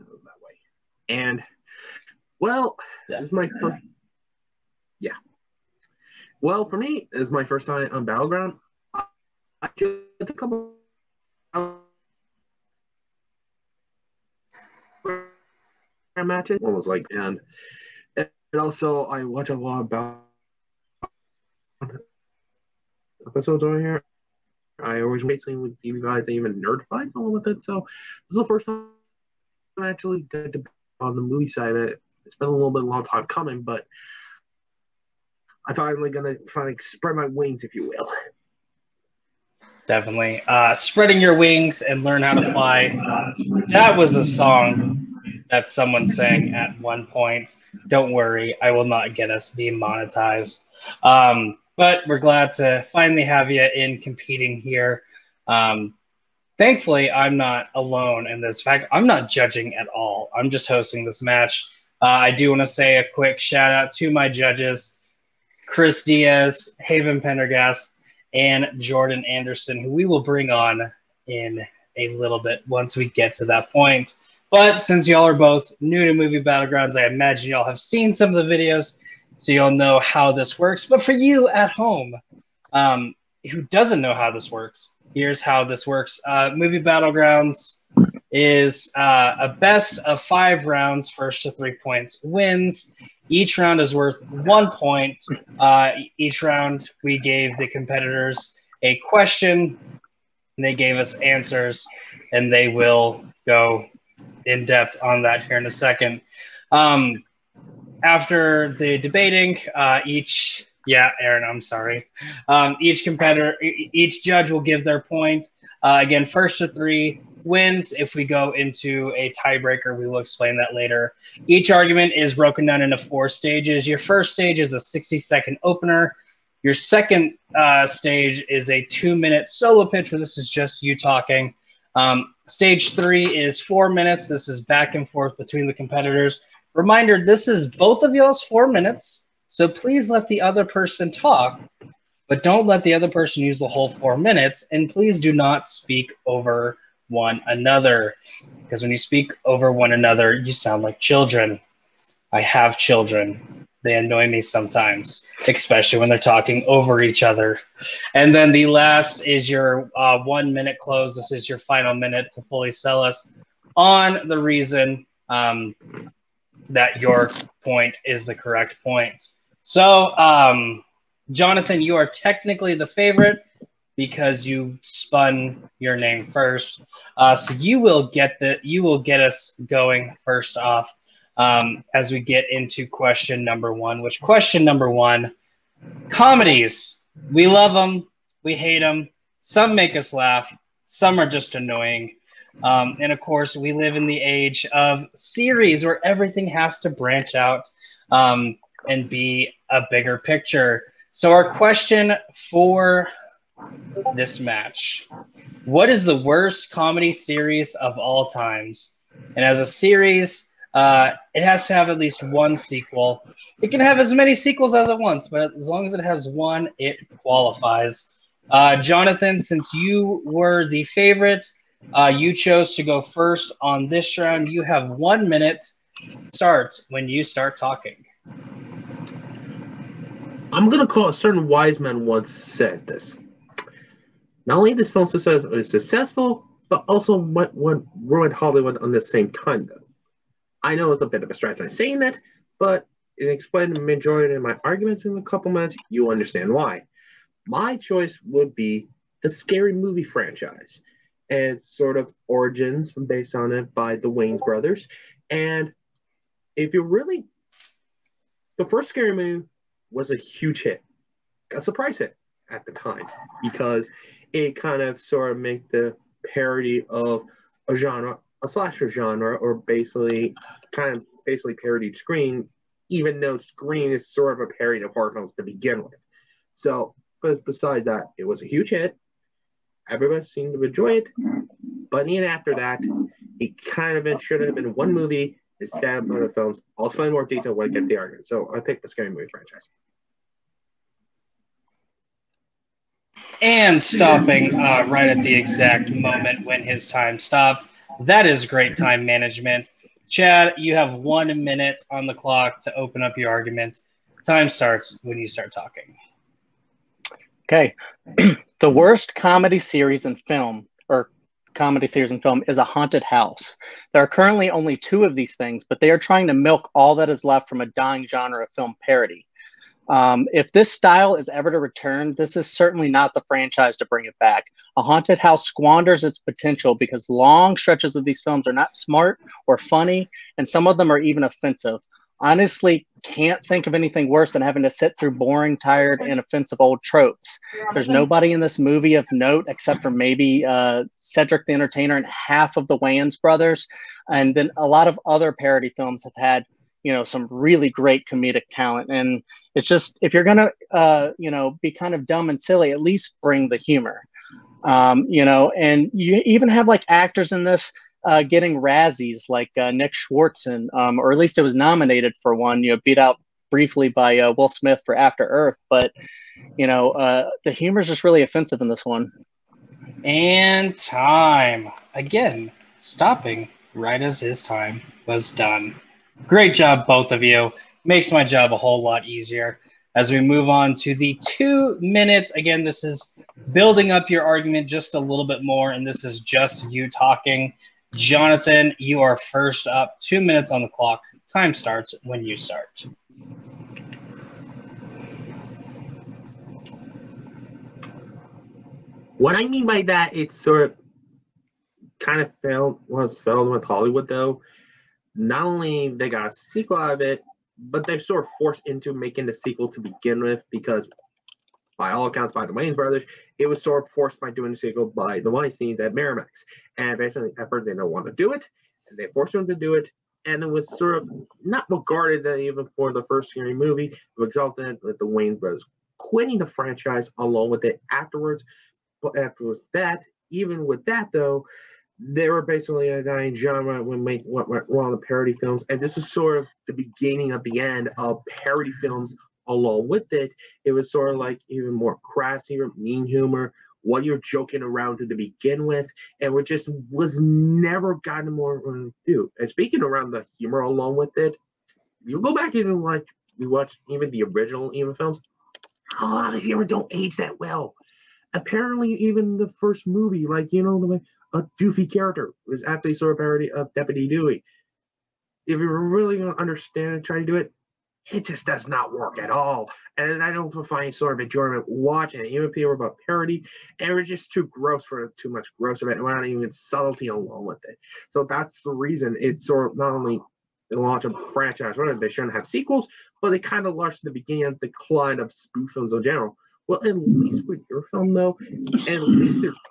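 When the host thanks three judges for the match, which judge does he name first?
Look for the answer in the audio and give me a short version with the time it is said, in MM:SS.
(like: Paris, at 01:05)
Chris Diaz, at 01:05.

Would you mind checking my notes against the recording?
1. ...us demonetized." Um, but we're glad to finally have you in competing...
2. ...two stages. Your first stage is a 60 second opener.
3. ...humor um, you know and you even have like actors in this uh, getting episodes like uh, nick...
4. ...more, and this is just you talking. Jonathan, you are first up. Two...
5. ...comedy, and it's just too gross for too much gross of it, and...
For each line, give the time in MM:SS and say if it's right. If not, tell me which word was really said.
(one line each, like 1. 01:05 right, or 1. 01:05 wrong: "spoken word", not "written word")
1. 00:49 right
2. 02:02 wrong: "four", not "two"
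3. 05:53 wrong: "razzies", not "episodes"
4. 06:25 right
5. 07:53 wrong: "parody", not "comedy".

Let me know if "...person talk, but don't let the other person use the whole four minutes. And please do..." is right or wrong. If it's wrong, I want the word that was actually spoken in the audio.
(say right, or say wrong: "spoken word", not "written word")
right.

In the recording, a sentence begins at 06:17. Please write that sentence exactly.
Makes my job a whole lot easier.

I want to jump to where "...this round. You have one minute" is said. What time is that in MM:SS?
03:43.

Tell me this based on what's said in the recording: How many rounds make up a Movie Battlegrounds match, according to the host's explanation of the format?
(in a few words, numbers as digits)
5.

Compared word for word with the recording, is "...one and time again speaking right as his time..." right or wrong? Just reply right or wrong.
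wrong.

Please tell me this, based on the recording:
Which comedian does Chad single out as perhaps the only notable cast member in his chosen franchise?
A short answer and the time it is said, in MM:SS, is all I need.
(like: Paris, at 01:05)
Cedric the Entertainer, at 05:41.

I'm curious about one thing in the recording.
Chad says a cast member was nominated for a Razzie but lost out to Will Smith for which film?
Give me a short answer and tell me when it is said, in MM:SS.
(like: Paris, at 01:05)
After Earth, at 06:04.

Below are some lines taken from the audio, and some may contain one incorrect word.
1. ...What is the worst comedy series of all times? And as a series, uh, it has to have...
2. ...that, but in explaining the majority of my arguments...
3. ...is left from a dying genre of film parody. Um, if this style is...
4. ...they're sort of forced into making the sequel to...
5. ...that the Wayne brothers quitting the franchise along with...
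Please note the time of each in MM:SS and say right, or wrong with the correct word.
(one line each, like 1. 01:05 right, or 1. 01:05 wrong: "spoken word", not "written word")
1. 03:25 right
2. 04:02 right
3. 05:17 right
4. 06:47 right
5. 07:04 right.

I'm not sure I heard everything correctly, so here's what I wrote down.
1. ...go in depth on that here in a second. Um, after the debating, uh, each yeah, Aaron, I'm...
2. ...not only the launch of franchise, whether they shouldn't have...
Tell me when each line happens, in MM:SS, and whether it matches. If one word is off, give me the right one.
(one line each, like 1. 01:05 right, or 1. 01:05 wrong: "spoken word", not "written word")
1. 01:43 right
2. 07:59 right.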